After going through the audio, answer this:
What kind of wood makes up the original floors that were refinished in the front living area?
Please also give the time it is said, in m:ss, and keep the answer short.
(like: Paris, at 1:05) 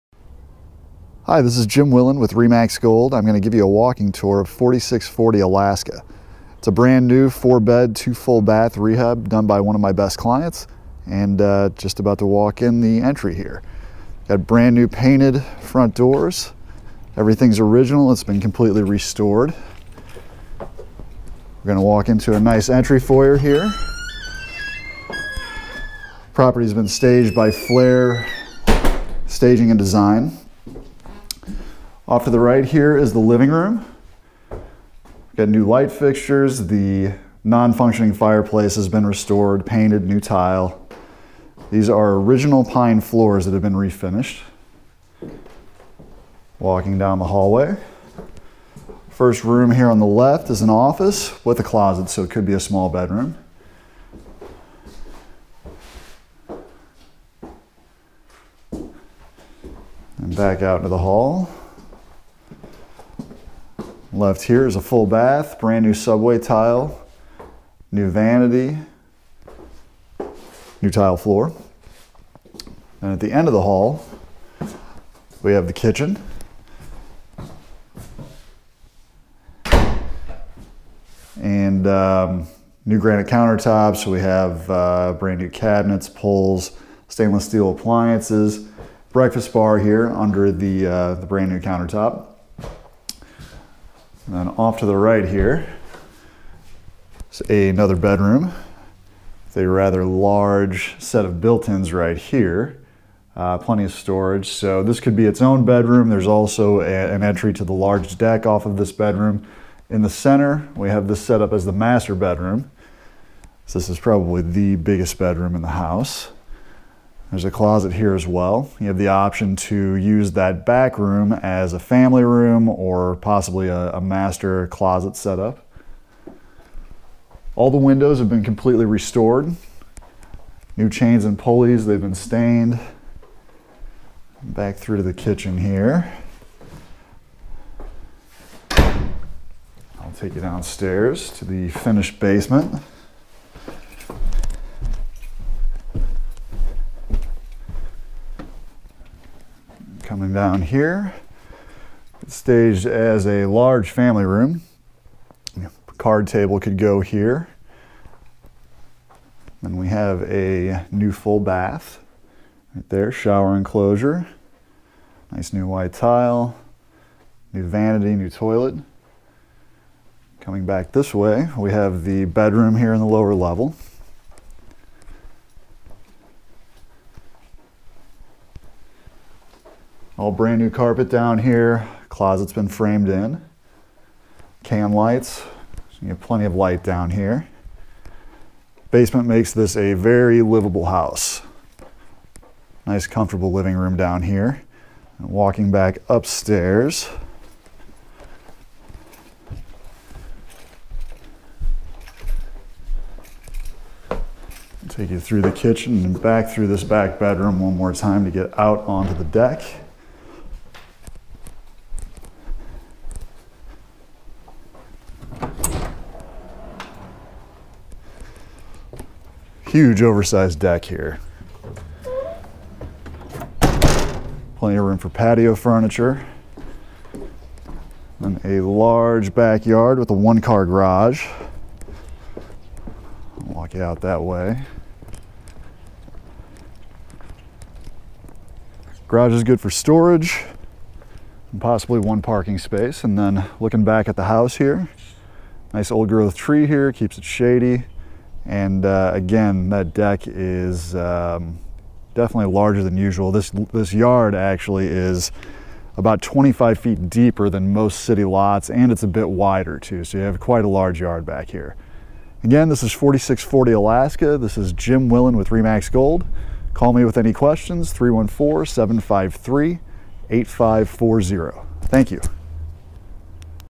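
Pine, at 0:42.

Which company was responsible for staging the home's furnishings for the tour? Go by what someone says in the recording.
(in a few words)
Flair Staging and Design.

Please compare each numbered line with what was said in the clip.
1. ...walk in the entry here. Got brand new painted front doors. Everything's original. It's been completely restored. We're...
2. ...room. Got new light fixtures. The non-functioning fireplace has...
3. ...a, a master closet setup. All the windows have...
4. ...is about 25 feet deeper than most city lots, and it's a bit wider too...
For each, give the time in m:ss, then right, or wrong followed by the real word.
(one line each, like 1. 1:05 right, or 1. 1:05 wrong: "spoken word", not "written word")
1. 0:12 right
2. 0:33 right
3. 2:03 right
4. 4:14 right.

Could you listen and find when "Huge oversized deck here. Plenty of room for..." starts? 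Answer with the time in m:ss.
3:39.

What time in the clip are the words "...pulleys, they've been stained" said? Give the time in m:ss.
2:11.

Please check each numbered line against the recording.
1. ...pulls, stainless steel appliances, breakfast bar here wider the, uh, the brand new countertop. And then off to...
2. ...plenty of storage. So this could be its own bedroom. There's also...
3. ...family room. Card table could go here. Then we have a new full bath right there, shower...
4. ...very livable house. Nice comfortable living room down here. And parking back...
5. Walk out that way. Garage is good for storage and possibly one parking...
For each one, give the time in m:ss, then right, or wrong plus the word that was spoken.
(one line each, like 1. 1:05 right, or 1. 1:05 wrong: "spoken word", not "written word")
1. 1:26 wrong: "under", not "wider"
2. 1:43 right
3. 2:33 right
4. 3:09 wrong: "walking", not "parking"
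5. 3:53 right.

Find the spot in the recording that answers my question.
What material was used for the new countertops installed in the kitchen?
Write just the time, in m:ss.
1:22.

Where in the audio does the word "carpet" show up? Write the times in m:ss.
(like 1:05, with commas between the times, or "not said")
3:00.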